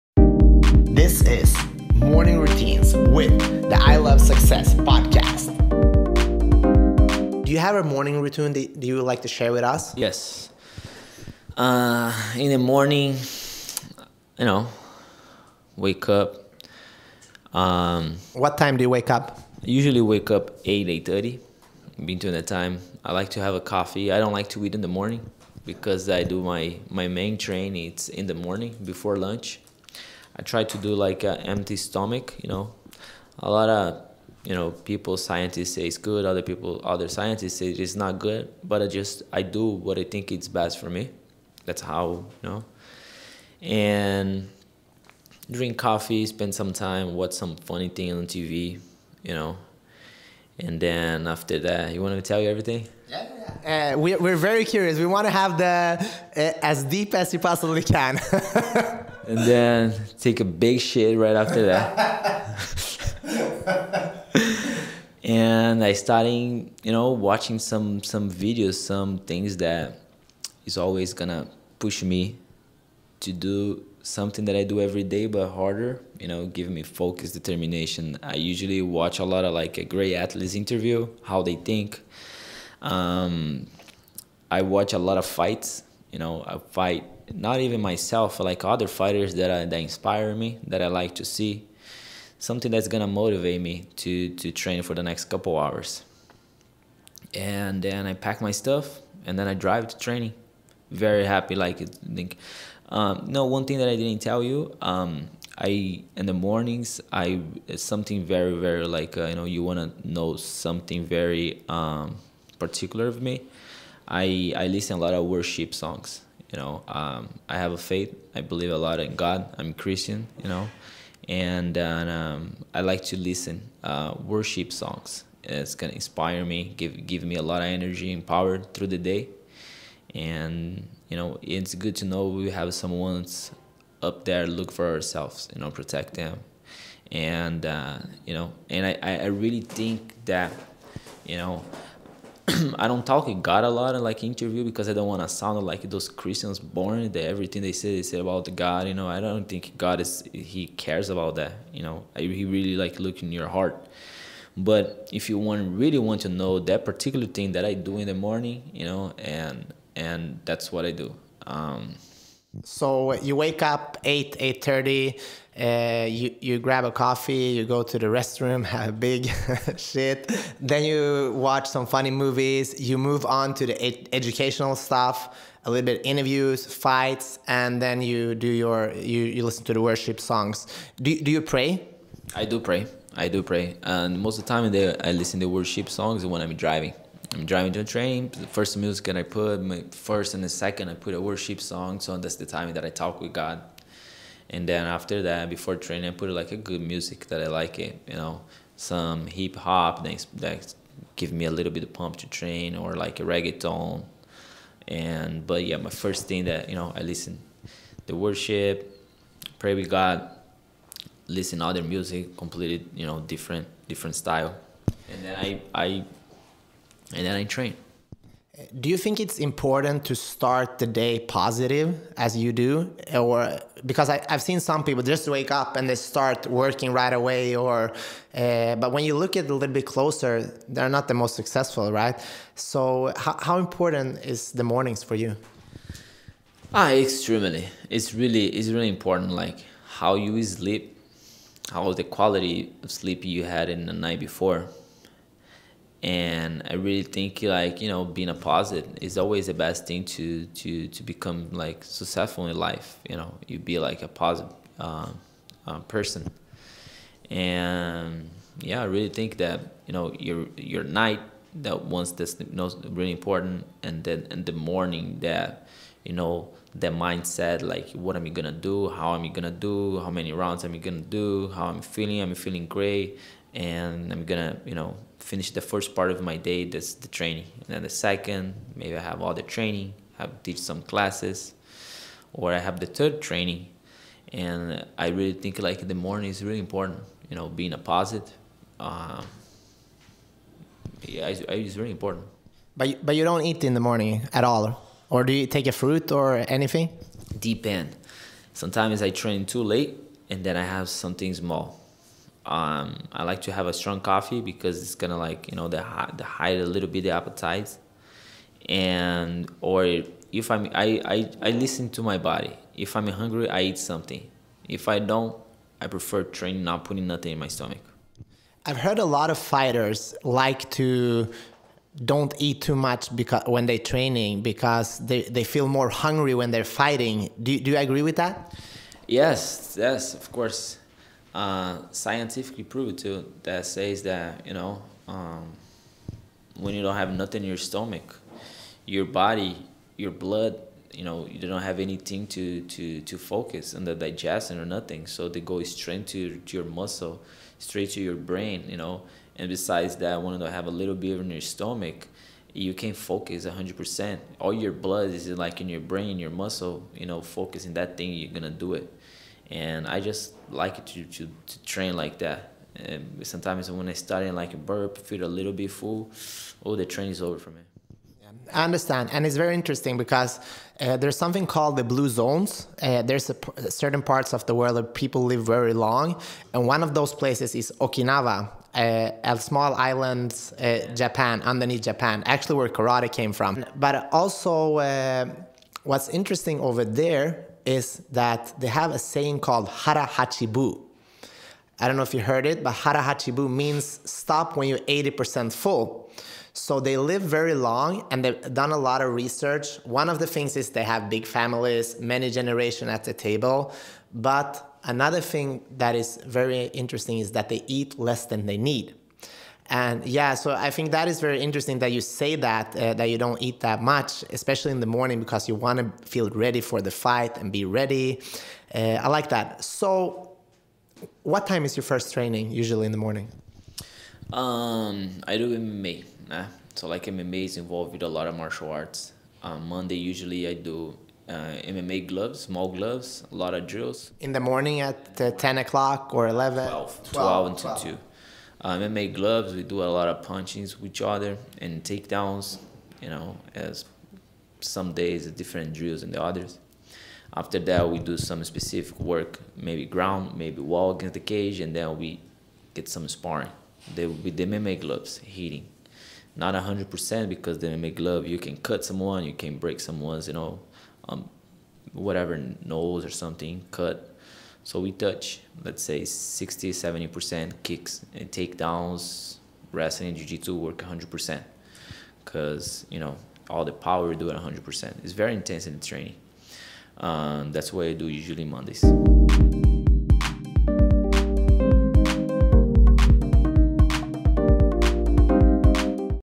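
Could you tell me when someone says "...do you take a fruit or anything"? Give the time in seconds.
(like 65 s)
295 s.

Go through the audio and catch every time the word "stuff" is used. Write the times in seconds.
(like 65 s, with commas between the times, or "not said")
98 s, 174 s.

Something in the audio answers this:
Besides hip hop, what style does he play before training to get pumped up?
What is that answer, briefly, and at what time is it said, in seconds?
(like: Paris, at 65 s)
reggaeton, at 203 s.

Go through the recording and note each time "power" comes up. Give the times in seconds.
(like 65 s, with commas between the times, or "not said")
128 s, 473 s.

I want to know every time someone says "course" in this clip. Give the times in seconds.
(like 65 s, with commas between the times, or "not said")
330 s.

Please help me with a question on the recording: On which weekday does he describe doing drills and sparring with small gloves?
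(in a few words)
Monday.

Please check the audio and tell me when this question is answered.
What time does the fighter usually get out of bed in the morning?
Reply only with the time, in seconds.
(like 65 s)
20 s.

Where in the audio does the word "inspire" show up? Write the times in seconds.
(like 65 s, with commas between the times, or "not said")
89 s, 125 s.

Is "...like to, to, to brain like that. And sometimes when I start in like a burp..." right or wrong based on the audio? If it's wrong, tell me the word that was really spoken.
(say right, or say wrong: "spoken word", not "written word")
wrong: "train", not "brain".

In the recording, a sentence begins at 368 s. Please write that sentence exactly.
I understand, and it's very interesting because uh, there's something called the blue zones.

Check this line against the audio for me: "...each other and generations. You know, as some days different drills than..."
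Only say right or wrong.
wrong.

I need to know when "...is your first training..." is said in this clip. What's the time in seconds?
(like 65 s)
421 s.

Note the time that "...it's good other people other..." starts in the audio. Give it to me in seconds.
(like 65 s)
35 s.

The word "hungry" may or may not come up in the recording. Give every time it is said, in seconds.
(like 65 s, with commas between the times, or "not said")
313 s, 325 s.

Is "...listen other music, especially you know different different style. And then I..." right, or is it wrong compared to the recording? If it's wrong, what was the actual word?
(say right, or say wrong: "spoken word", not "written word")
wrong: "completely", not "especially".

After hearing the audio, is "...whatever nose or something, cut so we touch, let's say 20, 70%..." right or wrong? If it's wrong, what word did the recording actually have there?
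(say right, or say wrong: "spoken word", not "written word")
wrong: "60", not "20".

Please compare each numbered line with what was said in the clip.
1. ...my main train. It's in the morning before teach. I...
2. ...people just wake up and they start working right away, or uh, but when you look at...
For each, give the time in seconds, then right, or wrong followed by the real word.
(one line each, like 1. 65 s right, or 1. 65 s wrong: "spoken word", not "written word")
1. 26 s wrong: "lunch", not "teach"
2. 224 s right.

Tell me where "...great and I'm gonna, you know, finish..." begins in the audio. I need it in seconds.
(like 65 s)
272 s.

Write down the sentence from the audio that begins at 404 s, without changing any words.
But another thing that is very interesting is that they eat less than they need.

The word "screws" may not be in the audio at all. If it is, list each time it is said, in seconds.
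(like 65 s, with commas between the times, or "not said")
not said.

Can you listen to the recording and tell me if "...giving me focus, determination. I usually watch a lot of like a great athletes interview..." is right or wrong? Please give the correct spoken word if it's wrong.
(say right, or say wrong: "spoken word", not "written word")
right.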